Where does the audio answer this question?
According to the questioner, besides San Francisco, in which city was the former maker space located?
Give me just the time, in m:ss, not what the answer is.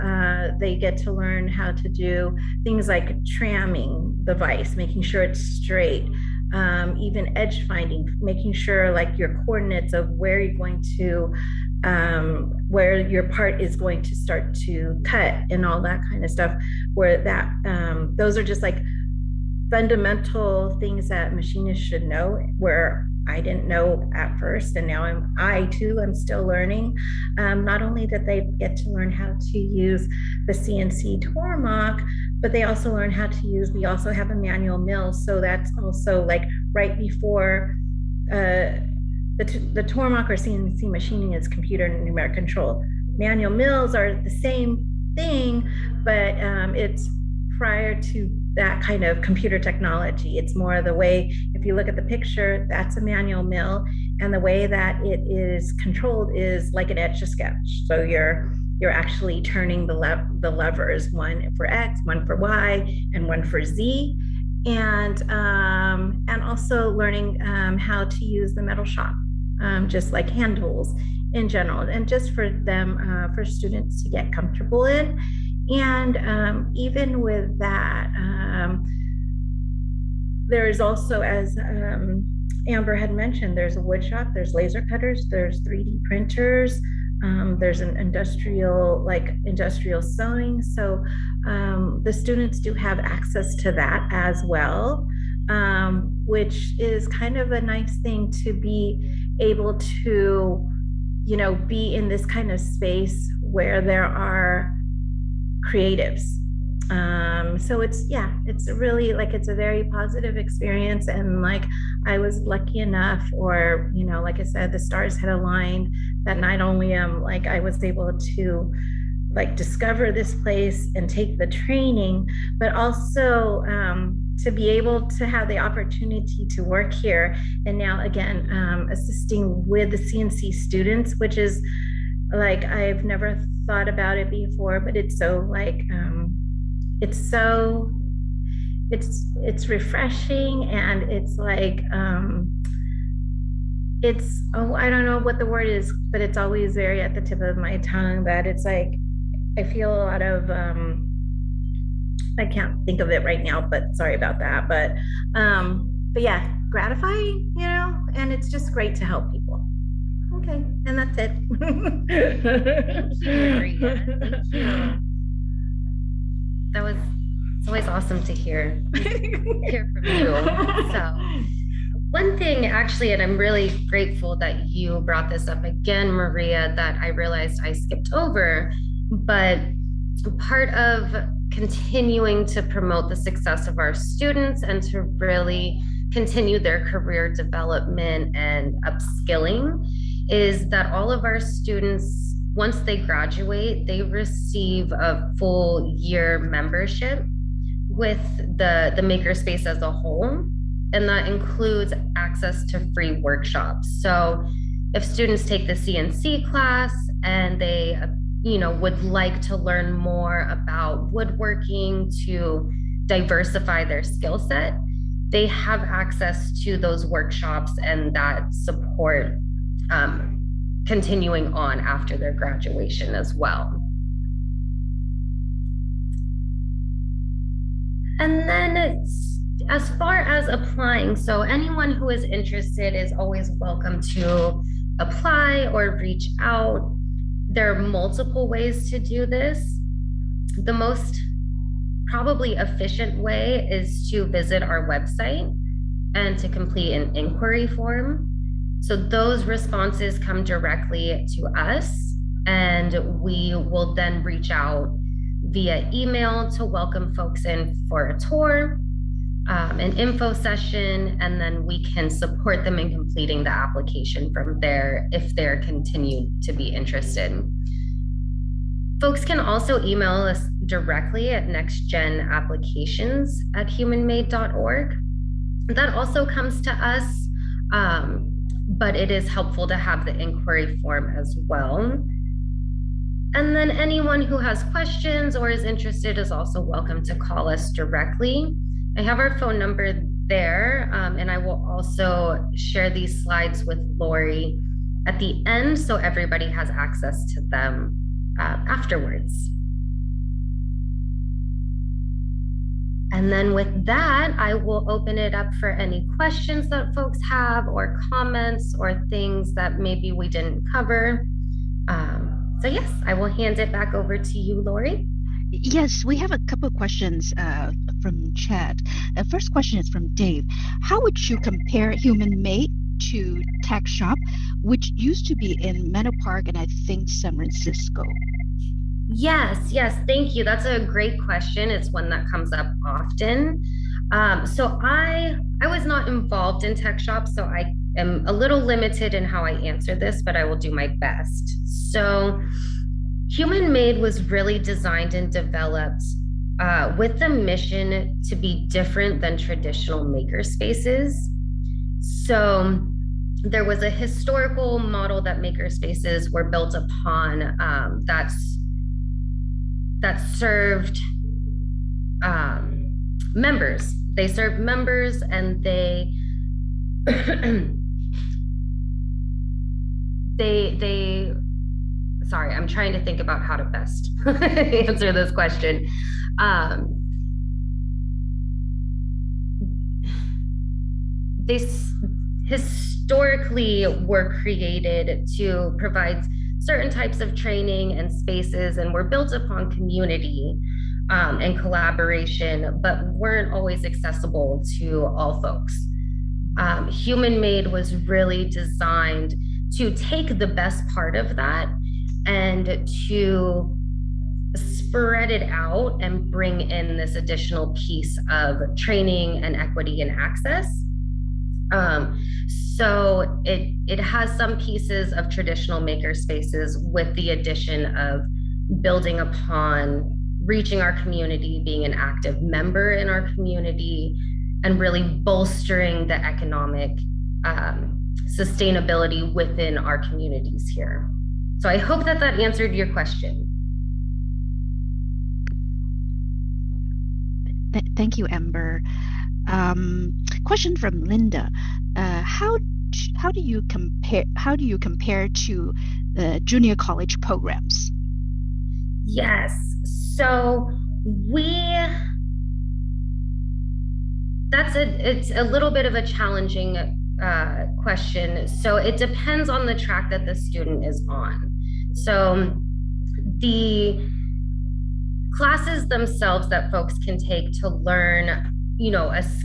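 5:25.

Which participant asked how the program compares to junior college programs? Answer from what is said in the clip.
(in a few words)
Linda.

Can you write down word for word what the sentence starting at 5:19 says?
Uh, first question is from Dave.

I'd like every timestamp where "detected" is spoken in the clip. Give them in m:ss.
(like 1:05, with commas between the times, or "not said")
not said.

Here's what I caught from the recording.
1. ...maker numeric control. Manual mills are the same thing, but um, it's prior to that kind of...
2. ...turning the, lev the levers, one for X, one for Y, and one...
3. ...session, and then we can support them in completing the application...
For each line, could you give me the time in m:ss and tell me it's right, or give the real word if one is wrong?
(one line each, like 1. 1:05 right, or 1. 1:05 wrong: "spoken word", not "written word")
1. 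0:41 wrong: "computer", not "maker"
2. 0:59 right
3. 4:20 right.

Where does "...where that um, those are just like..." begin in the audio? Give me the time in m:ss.
0:16.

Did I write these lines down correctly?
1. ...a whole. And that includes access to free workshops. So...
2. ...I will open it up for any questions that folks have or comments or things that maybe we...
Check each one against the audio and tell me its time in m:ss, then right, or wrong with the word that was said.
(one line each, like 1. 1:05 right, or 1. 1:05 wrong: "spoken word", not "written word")
1. 3:19 right
2. 5:04 right.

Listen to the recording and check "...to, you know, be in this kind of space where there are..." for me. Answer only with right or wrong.
right.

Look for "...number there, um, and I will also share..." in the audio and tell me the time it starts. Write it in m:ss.
4:49.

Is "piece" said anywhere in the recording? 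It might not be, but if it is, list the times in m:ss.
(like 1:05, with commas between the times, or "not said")
6:47, 6:54.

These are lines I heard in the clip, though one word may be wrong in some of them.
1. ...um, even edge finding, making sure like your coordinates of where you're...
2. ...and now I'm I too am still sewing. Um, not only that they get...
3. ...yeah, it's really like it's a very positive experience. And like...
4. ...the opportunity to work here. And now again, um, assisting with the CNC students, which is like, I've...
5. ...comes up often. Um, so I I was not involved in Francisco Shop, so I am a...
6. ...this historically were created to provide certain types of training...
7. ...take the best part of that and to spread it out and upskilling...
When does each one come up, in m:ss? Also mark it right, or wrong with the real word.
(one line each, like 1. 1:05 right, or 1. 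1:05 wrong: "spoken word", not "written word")
1. 0:06 right
2. 0:24 wrong: "learning", not "sewing"
3. 1:48 right
4. 2:05 right
5. 5:32 wrong: "Tech", not "Francisco"
6. 6:21 right
7. 6:39 wrong: "bring", not "upskilling".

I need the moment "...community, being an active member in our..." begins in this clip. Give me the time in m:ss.
7:00.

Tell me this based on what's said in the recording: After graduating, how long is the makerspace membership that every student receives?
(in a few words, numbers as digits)
A full year.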